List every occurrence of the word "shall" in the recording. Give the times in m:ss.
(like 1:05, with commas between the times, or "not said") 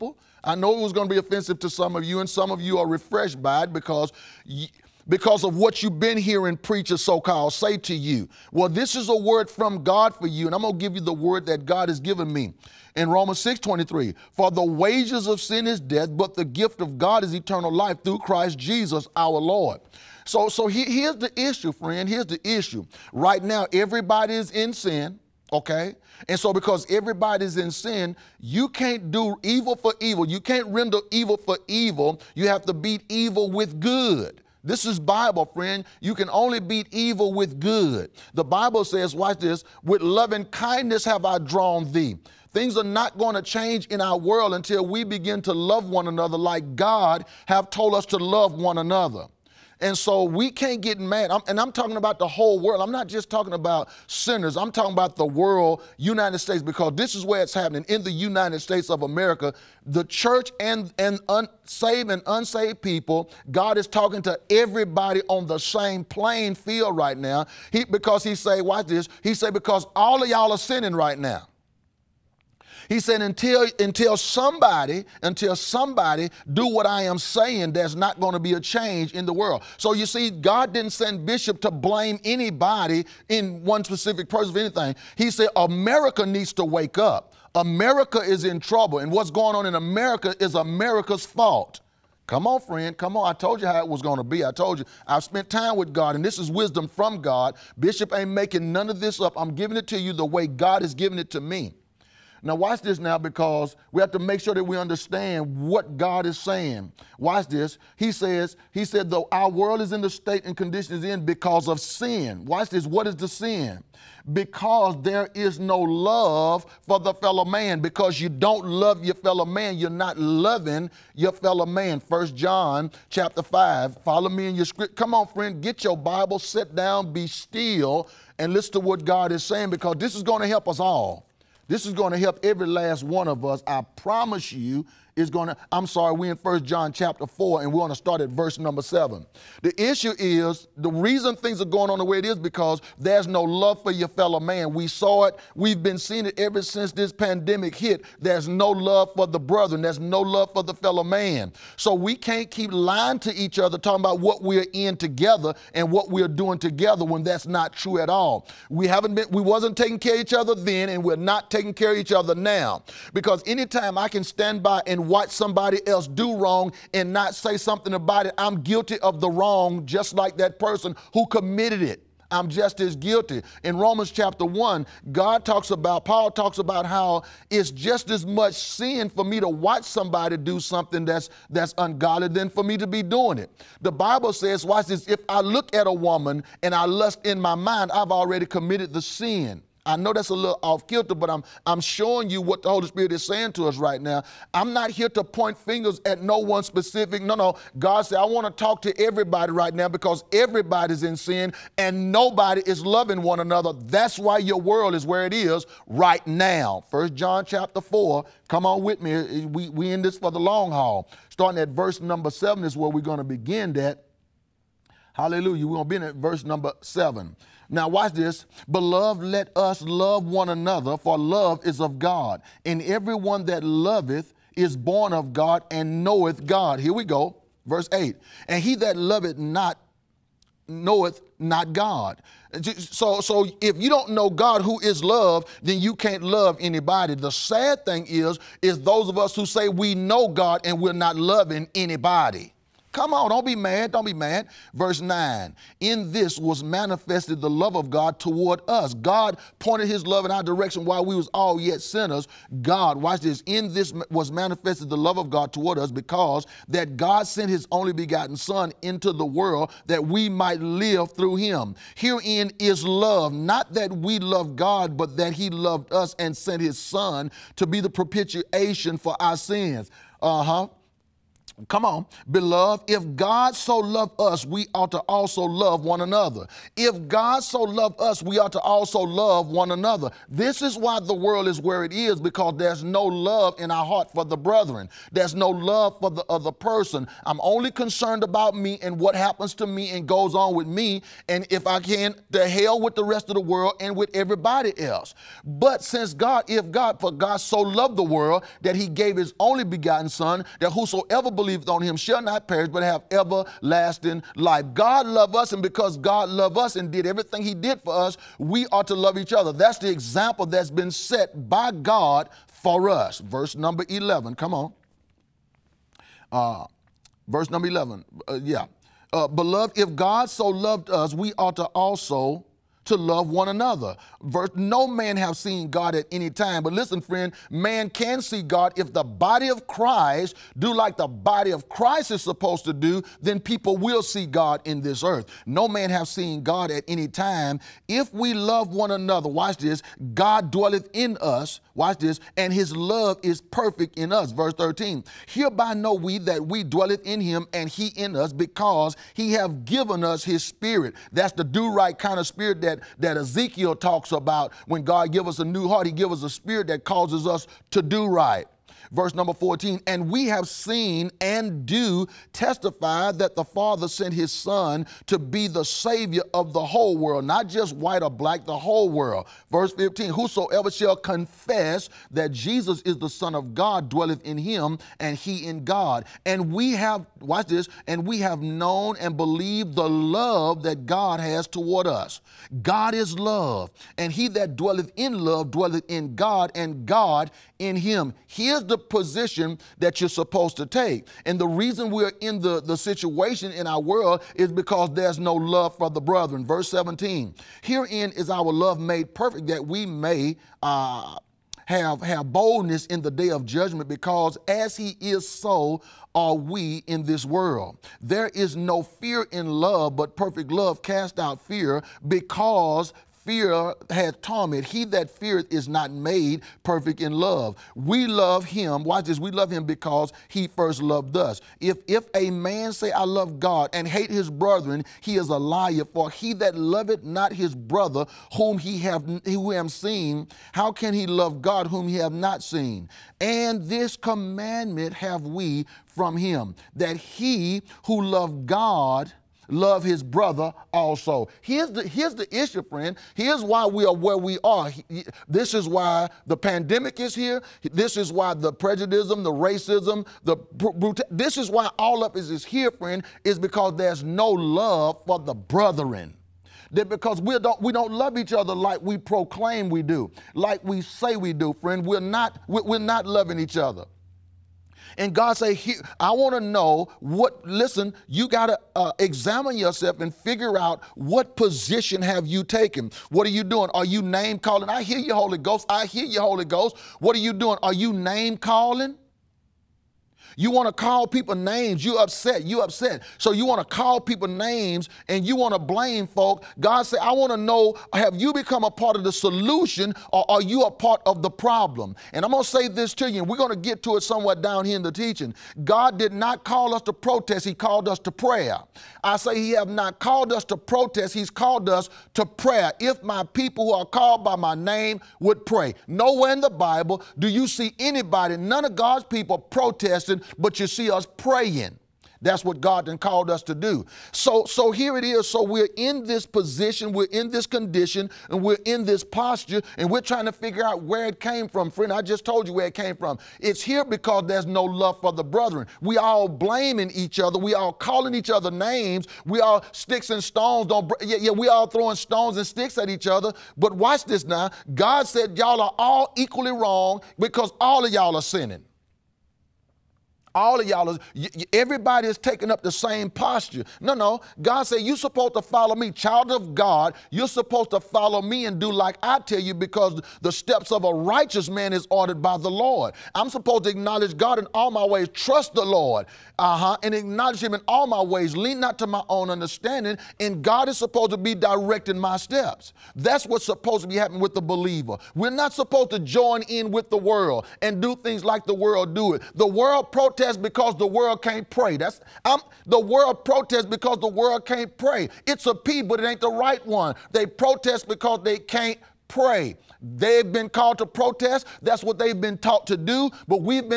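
5:01, 6:10.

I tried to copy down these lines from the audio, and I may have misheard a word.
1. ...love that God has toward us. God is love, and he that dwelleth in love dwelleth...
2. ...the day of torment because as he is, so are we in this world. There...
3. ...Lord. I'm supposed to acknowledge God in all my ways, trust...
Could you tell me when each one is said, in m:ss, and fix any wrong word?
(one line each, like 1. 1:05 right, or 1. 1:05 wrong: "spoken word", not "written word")
1. 6:19 right
2. 6:43 wrong: "judgment", not "torment"
3. 9:12 right.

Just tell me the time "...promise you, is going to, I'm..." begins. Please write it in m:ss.
2:13.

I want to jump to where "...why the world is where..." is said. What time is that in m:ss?
4:40.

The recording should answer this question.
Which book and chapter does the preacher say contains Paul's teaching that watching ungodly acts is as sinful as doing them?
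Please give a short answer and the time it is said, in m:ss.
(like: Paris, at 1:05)
Romans chapter 1, at 2:53.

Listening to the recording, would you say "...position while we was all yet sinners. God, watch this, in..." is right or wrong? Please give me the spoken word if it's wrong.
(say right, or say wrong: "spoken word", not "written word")
wrong: "direction", not "position".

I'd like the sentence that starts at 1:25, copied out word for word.
He said, America needs to wake up.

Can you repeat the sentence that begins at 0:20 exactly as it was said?
So, so he, here's the issue, friend.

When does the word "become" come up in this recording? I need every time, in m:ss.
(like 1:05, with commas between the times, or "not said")
8:08.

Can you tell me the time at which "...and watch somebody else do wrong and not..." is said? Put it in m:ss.
2:44.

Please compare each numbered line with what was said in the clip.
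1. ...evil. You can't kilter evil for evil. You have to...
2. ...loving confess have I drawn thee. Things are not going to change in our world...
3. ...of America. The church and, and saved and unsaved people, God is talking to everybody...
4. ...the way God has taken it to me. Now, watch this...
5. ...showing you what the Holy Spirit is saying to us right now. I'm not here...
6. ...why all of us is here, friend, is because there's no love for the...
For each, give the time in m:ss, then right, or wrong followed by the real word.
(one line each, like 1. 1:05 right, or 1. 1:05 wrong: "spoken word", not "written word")
1. 0:29 wrong: "render", not "kilter"
2. 0:40 wrong: "kindness", not "confess"
3. 0:58 right
4. 1:40 wrong: "given", not "taken"
5. 3:11 right
6. 7:31 right.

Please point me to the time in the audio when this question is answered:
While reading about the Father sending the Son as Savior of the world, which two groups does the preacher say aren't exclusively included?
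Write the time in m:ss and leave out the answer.
6:07.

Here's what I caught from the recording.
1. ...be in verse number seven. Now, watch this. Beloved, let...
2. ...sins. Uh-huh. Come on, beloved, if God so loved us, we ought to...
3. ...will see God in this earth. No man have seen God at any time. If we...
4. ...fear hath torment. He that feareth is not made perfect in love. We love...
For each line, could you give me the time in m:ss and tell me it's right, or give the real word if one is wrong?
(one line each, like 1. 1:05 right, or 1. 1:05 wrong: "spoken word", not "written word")
1. 3:35 right
2. 4:29 right
3. 5:33 right
4. 6:53 right.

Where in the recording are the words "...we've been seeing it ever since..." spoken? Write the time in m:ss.
2:25.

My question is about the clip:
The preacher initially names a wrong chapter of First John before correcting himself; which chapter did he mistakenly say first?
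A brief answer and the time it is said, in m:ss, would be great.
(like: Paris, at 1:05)
Chapter 5, at 2:01.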